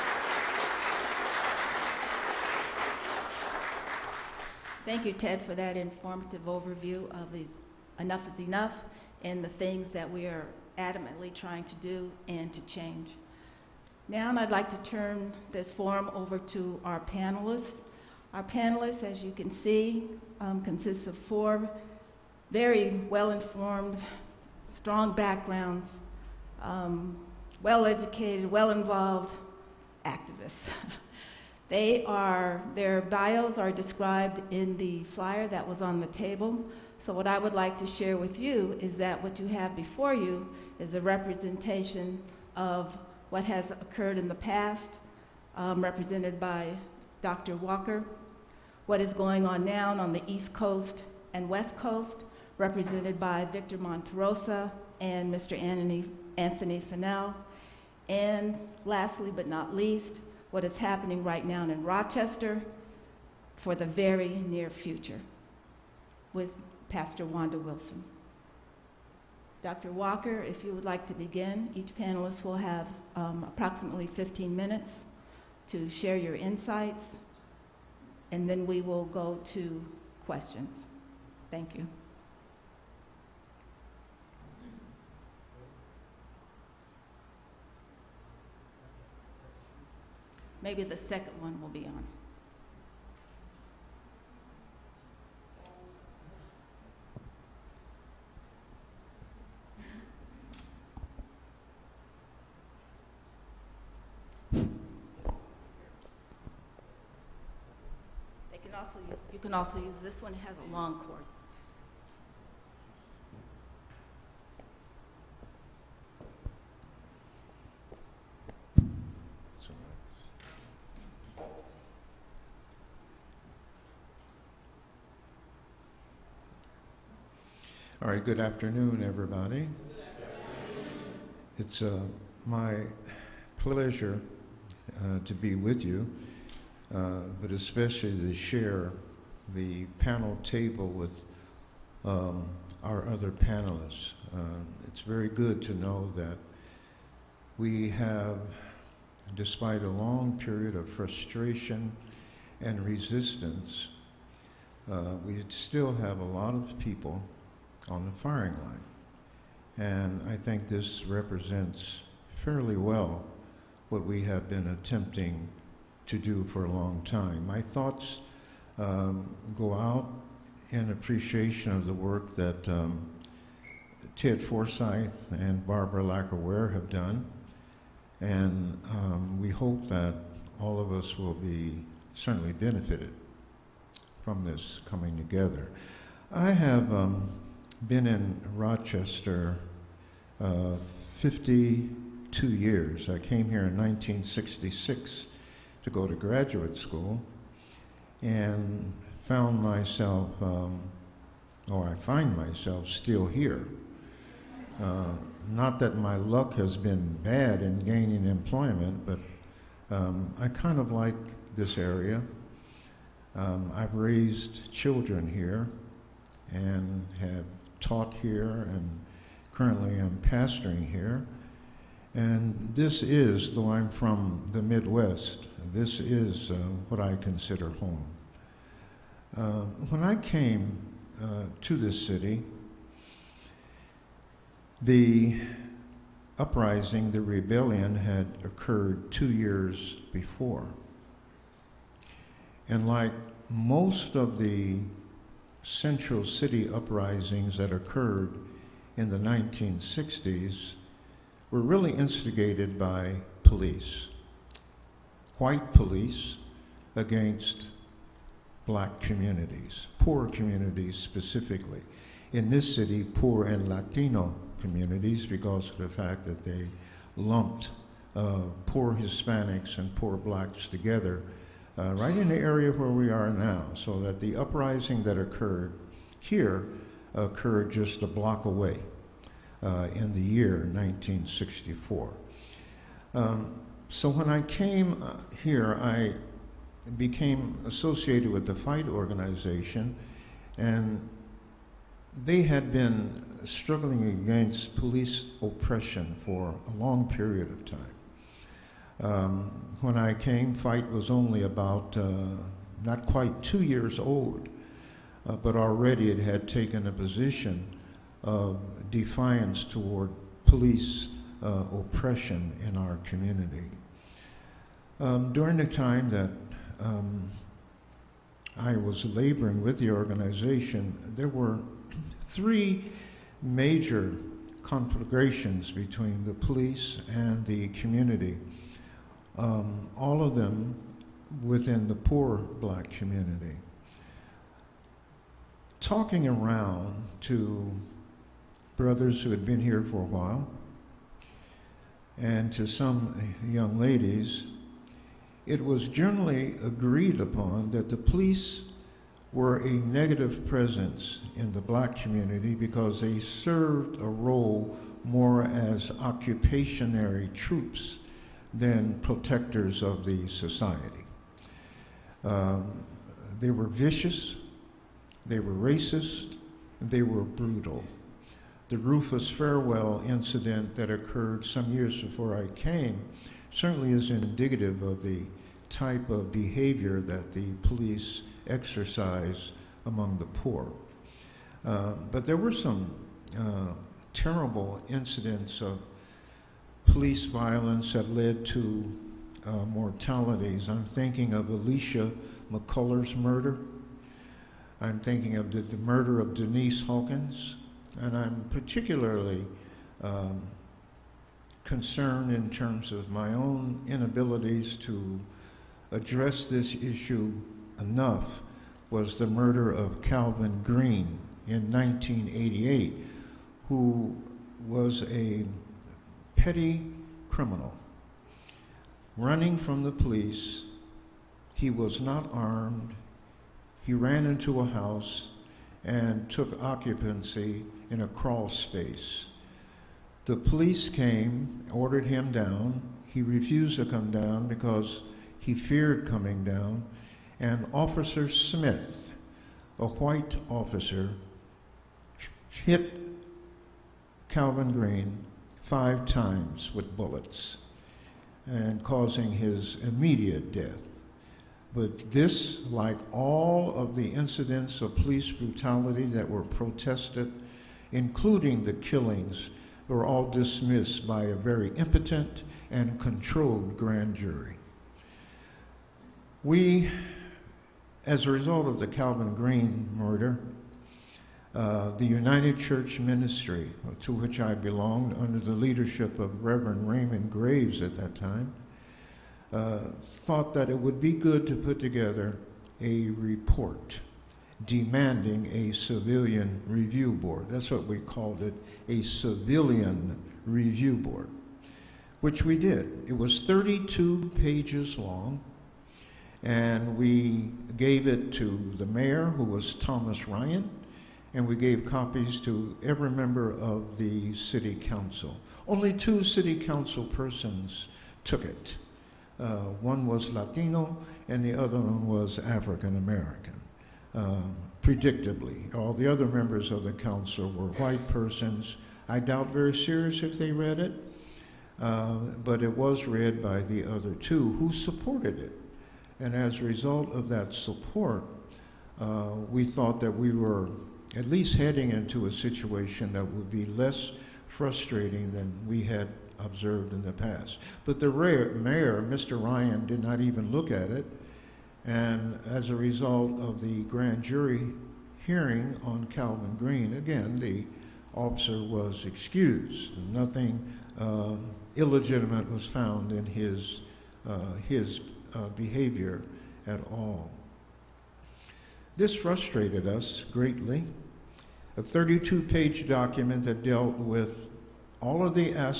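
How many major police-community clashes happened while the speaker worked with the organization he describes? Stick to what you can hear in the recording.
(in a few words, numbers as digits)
3.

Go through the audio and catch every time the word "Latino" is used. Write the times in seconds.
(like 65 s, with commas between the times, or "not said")
263 s, 510 s.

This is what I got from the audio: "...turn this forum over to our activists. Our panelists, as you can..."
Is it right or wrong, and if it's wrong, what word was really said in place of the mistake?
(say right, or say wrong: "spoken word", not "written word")
wrong: "panelists", not "activists".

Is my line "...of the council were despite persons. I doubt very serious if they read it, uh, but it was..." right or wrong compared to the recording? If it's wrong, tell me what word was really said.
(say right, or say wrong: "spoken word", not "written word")
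wrong: "white", not "despite".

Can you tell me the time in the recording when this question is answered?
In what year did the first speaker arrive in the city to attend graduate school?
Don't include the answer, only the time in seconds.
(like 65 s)
193 s.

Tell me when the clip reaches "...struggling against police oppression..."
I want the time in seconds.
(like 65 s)
293 s.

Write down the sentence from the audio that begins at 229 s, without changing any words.
Uh, when I came uh, to this city, the uprising, the rebellion, had occurred two years before.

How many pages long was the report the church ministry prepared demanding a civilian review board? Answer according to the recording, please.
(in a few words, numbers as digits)
32.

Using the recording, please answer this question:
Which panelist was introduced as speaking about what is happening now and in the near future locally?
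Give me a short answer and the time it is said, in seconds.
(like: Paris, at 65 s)
Pastor Wanda Wilson, at 66 s.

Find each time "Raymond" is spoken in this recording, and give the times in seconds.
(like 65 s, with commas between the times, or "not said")
476 s.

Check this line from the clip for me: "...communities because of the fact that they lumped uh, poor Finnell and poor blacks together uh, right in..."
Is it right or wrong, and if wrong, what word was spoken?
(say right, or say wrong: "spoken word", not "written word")
wrong: "Hispanics", not "Finnell".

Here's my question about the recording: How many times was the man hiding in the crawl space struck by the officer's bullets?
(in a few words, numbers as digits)
5.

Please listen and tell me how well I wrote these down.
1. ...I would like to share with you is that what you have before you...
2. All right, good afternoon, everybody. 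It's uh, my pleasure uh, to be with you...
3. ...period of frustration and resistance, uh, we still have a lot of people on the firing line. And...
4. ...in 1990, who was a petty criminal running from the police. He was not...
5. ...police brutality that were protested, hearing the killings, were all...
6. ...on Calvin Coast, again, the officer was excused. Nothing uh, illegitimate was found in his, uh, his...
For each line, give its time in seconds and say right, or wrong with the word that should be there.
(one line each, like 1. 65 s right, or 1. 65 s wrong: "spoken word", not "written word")
1. 37 s right
2. 128 s right
3. 150 s right
4. 411 s wrong: "1988", not "1990"
5. 454 s wrong: "including", not "hearing"
6. 545 s wrong: "Green", not "Coast".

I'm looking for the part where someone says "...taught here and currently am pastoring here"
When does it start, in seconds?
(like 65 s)
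217 s.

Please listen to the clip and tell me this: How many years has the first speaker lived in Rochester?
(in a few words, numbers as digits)
52.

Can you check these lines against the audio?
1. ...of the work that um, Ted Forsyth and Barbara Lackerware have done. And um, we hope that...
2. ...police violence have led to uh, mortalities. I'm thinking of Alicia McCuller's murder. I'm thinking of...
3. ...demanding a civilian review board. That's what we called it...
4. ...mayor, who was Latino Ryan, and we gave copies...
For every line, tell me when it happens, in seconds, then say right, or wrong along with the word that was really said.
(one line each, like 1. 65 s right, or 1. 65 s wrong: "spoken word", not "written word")
1. 171 s right
2. 386 s right
3. 484 s right
4. 498 s wrong: "Thomas", not "Latino".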